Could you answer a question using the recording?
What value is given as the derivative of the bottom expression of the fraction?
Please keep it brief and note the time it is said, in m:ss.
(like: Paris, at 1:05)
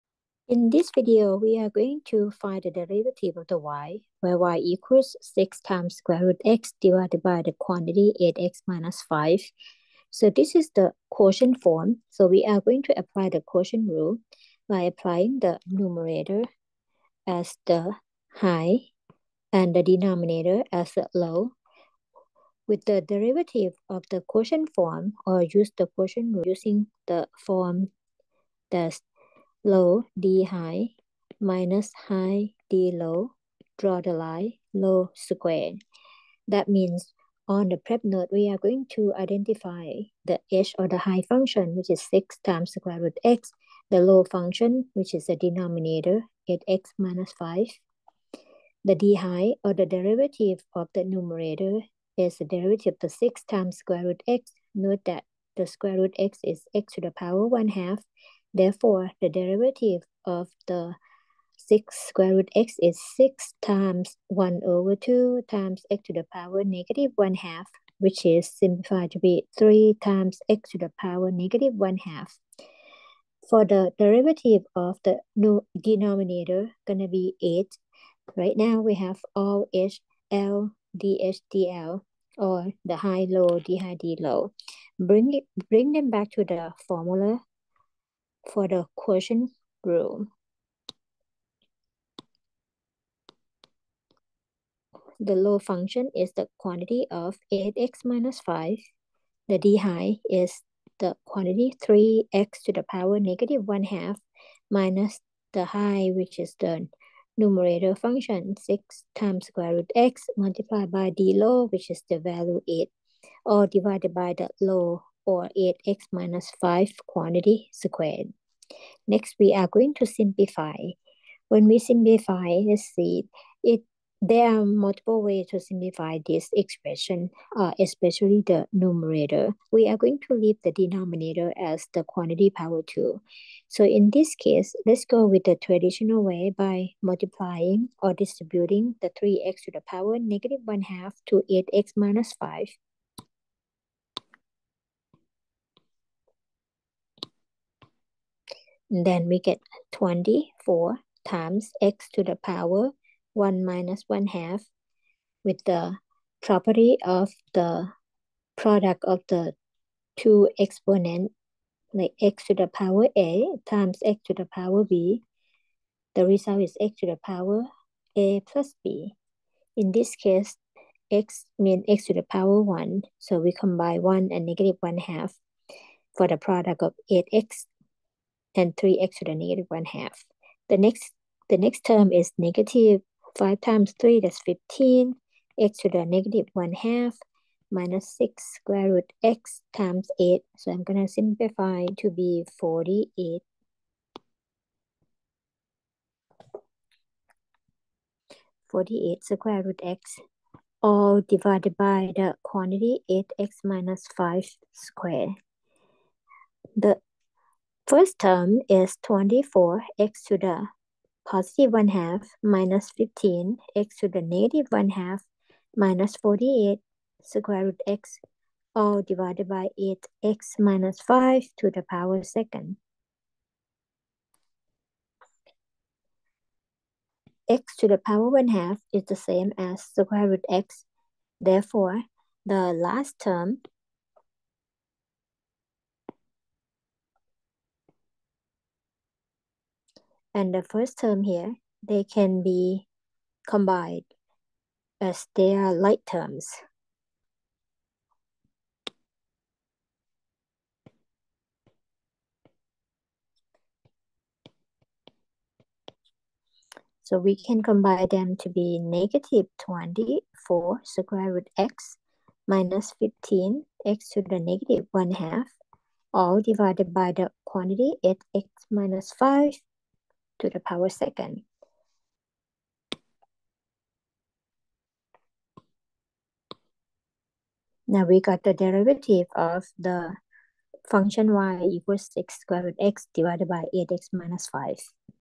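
8, at 1:16.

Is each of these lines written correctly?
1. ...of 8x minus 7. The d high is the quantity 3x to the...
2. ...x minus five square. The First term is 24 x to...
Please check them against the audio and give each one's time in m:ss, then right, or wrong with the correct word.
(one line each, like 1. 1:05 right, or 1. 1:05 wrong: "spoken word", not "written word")
1. 1:37 wrong: "5", not "7"
2. 3:23 right.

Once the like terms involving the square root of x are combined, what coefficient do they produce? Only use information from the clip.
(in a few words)
-24.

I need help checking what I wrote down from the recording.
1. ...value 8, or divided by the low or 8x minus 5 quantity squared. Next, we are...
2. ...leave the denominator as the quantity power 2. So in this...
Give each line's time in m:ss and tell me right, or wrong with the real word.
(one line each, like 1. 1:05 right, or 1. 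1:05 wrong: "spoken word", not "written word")
1. 1:52 right
2. 2:10 right.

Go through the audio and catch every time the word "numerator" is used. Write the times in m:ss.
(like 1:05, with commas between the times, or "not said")
0:15, 0:51, 1:47, 2:08.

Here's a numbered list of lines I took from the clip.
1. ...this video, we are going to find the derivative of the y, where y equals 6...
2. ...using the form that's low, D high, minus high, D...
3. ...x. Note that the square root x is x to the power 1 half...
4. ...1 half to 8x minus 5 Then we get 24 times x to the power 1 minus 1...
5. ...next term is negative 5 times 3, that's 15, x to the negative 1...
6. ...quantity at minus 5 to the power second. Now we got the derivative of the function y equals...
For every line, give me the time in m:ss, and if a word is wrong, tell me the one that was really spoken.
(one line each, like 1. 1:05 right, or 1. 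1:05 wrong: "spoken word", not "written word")
1. 0:00 right
2. 0:26 right
3. 0:54 right
4. 2:20 right
5. 3:01 right
6. 4:27 right.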